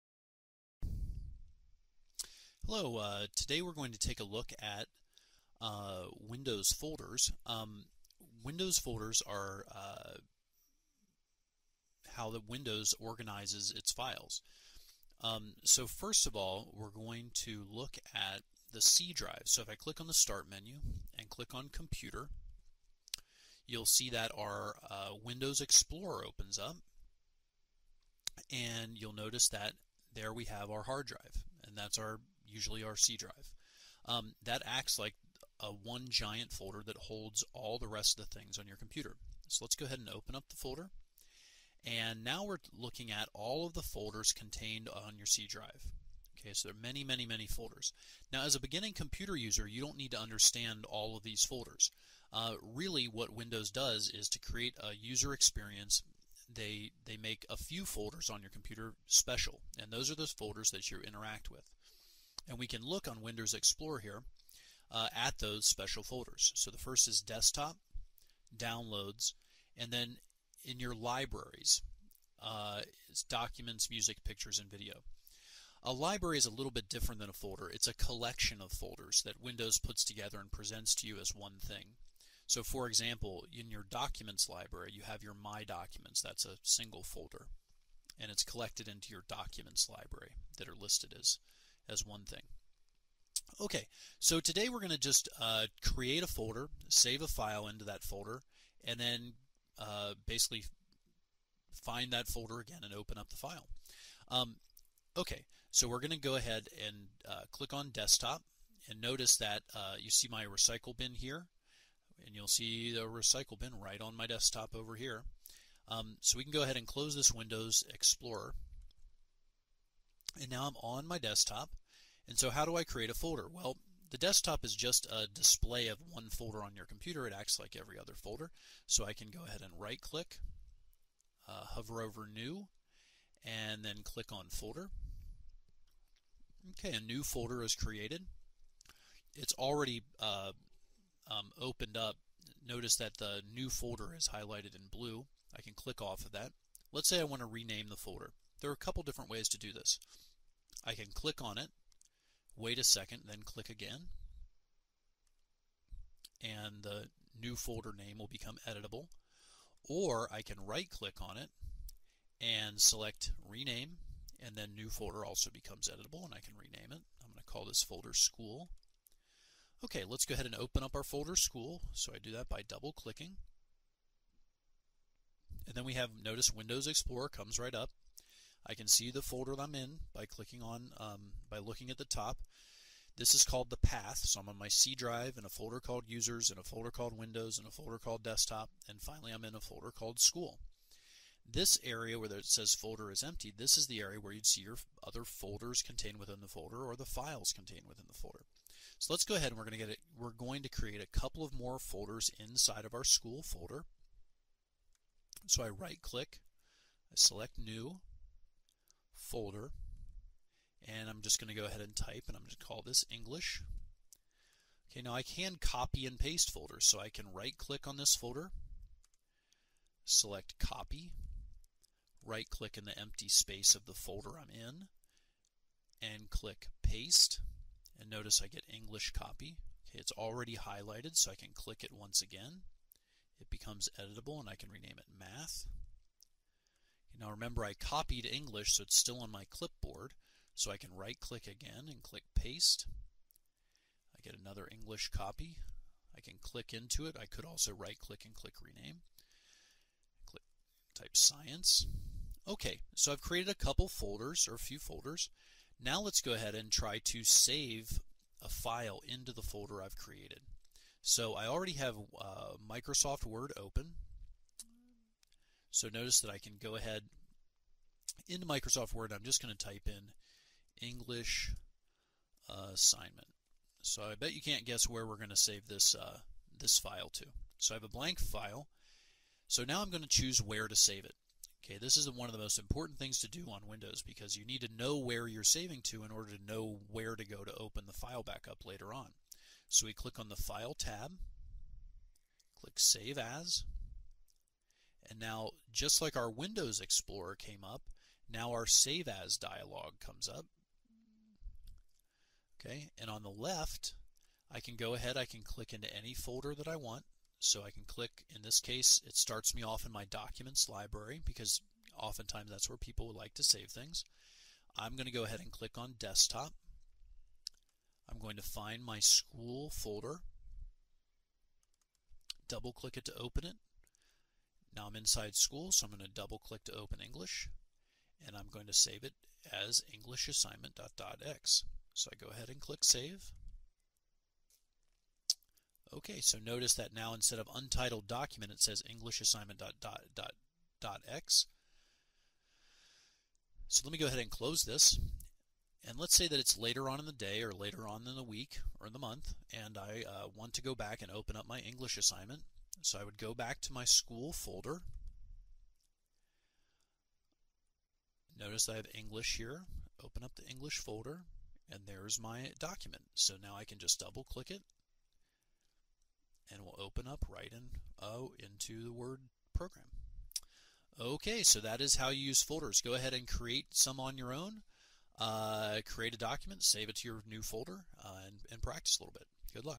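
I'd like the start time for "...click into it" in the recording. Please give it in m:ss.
4:06.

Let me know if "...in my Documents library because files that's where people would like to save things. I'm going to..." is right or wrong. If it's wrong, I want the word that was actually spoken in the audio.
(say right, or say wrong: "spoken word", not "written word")
wrong: "oftentimes", not "files".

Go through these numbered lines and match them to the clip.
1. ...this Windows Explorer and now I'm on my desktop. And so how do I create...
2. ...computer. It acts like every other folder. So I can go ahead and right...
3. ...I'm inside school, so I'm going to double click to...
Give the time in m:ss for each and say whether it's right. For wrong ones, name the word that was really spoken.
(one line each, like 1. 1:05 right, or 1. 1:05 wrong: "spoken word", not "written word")
1. 1:57 right
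2. 2:06 right
3. 5:24 right.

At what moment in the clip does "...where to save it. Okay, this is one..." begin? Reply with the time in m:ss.
4:40.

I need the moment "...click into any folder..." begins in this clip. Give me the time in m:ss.
5:05.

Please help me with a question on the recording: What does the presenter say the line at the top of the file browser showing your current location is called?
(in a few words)
the path.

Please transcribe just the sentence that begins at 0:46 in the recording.
Okay, so there are many, many, many folders.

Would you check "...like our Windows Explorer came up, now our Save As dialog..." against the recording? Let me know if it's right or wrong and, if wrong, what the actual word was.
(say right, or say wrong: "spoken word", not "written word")
right.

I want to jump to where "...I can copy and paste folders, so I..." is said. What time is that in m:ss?
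3:35.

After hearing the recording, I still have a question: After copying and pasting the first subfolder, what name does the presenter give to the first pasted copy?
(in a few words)
math.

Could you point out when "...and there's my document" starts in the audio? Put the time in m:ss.
6:01.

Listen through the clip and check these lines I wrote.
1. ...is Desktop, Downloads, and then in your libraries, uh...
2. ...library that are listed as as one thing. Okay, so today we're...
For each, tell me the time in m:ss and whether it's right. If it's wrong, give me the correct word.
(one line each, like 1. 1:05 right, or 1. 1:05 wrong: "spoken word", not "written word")
1. 1:07 right
2. 1:29 right.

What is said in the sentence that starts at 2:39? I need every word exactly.
Or I can right click on it and select rename, and then new folder also becomes editable, and I can rename it.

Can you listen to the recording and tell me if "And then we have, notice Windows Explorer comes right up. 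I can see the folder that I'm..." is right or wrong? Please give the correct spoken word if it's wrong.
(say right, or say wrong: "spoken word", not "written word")
right.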